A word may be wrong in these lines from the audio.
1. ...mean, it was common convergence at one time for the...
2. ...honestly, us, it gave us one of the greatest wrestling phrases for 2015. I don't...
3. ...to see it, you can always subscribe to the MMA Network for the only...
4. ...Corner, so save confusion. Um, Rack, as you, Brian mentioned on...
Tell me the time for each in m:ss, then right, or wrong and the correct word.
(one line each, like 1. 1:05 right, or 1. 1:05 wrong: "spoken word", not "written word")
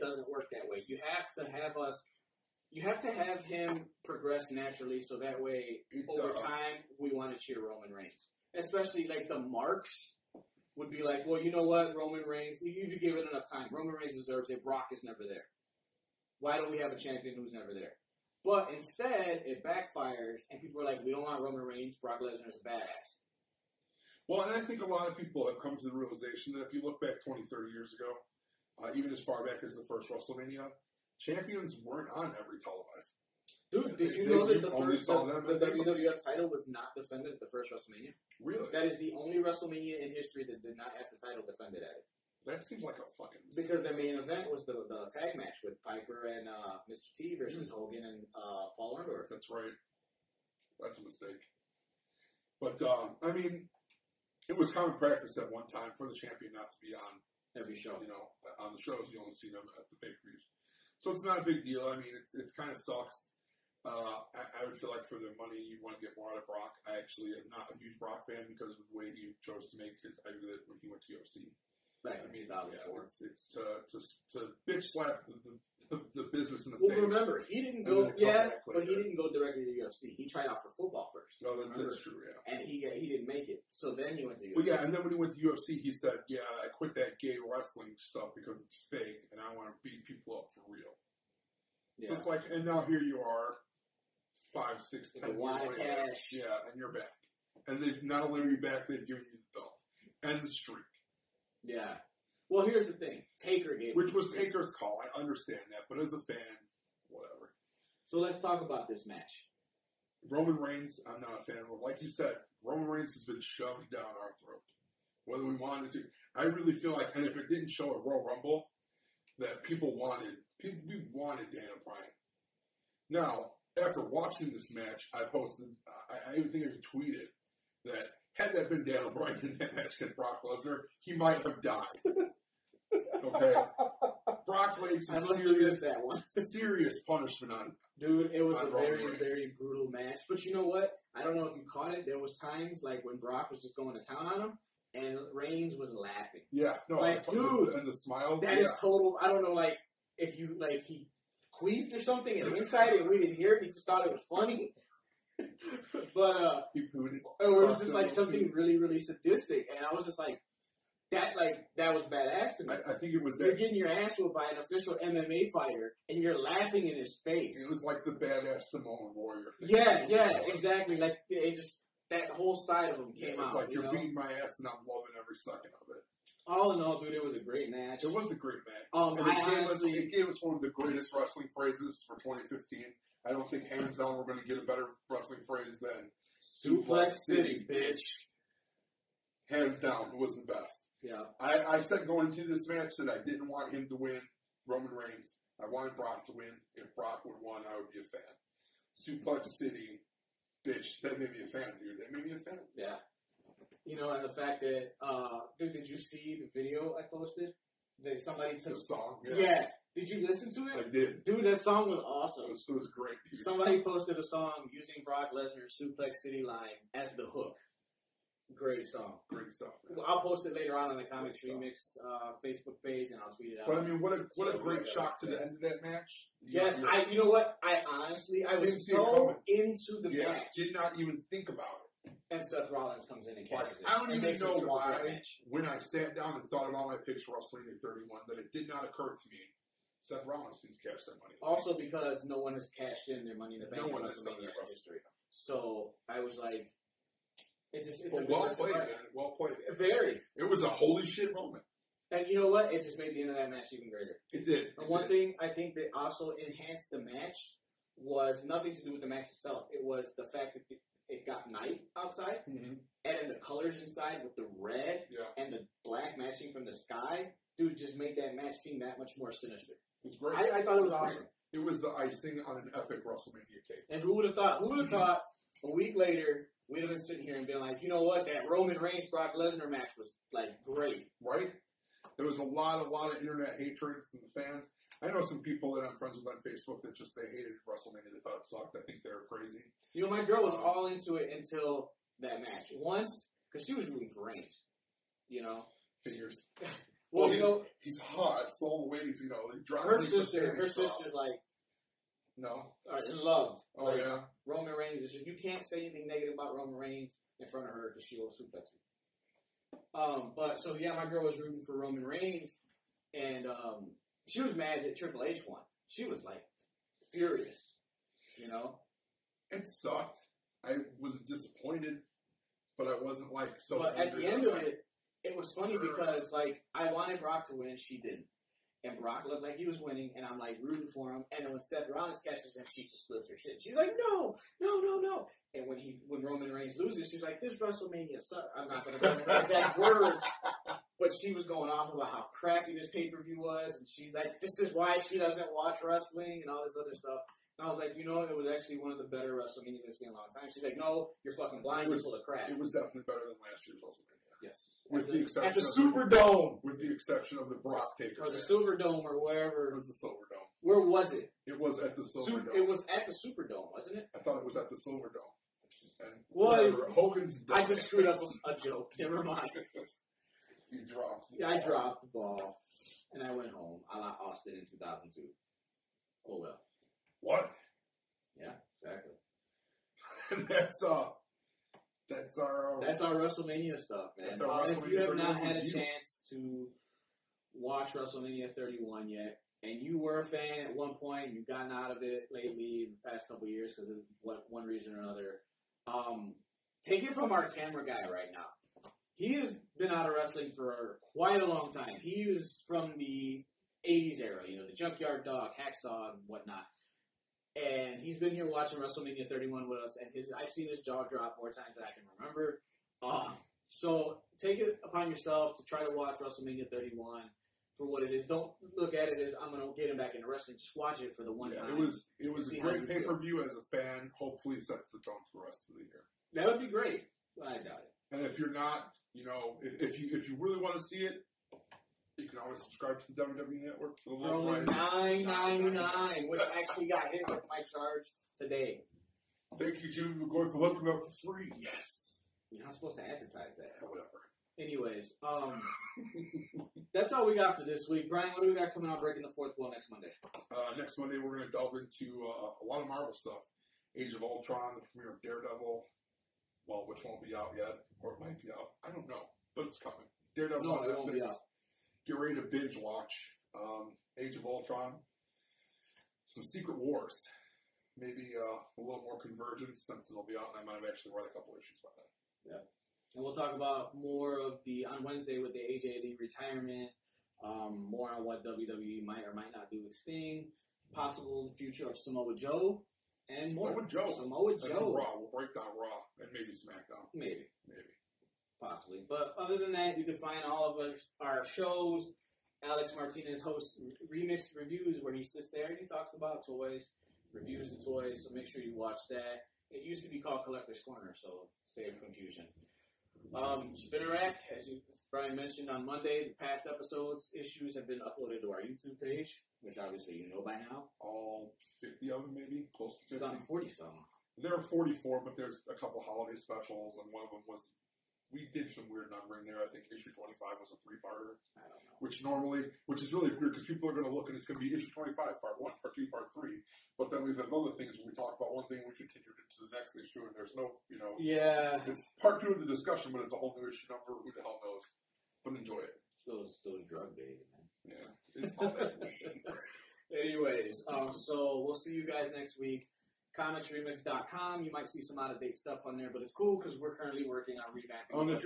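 1. 0:53 wrong: "practice", not "convergence"
2. 2:59 right
3. 7:10 wrong: "WWE", not "MMA"
4. 8:20 right.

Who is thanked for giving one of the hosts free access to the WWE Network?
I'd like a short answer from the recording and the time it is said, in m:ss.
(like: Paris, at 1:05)
Jimmy McGoy, at 7:19.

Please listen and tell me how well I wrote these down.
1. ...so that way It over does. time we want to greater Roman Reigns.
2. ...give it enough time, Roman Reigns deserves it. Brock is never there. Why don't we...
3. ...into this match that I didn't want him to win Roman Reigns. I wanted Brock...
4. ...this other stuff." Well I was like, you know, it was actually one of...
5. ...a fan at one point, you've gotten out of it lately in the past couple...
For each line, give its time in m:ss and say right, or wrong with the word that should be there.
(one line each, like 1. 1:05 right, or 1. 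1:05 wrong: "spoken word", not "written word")
1. 0:05 wrong: "cheer", not "greater"
2. 0:12 right
3. 3:12 right
4. 5:46 wrong: "And", not "Well"
5. 6:30 right.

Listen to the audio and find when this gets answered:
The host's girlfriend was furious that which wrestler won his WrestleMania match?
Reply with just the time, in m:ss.
5:14.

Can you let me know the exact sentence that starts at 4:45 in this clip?
I know some people that I'm friends with on Facebook that just they hated WrestleMania.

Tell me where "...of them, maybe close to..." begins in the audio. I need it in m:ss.
8:32.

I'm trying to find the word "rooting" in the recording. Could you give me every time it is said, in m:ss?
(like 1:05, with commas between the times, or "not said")
4:53, 5:11, 5:30.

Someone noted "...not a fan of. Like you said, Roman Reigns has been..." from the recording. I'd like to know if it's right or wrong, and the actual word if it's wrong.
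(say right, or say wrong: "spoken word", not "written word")
right.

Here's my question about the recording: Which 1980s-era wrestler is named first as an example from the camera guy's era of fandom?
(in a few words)
Junkyard Dog.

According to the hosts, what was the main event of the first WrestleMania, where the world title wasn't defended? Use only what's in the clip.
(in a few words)
Tag match.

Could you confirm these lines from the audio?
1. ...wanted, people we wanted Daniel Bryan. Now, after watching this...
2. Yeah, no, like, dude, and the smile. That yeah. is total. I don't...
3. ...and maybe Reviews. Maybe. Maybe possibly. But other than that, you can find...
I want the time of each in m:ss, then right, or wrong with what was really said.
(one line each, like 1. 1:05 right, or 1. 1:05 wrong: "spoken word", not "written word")
1. 1:59 right
2. 2:26 right
3. 8:06 wrong: "SmackDown", not "Reviews".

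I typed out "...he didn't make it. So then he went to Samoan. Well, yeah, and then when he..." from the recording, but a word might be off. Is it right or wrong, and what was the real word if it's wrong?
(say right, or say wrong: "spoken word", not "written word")
wrong: "UFC", not "Samoan".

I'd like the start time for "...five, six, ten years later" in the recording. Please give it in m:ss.
1:34.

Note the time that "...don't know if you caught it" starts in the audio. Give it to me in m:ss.
2:21.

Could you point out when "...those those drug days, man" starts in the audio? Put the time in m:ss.
8:56.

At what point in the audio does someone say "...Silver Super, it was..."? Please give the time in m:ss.
6:02.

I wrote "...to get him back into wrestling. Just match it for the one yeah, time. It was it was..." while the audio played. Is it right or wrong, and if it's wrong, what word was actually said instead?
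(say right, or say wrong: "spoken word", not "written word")
wrong: "watch", not "match".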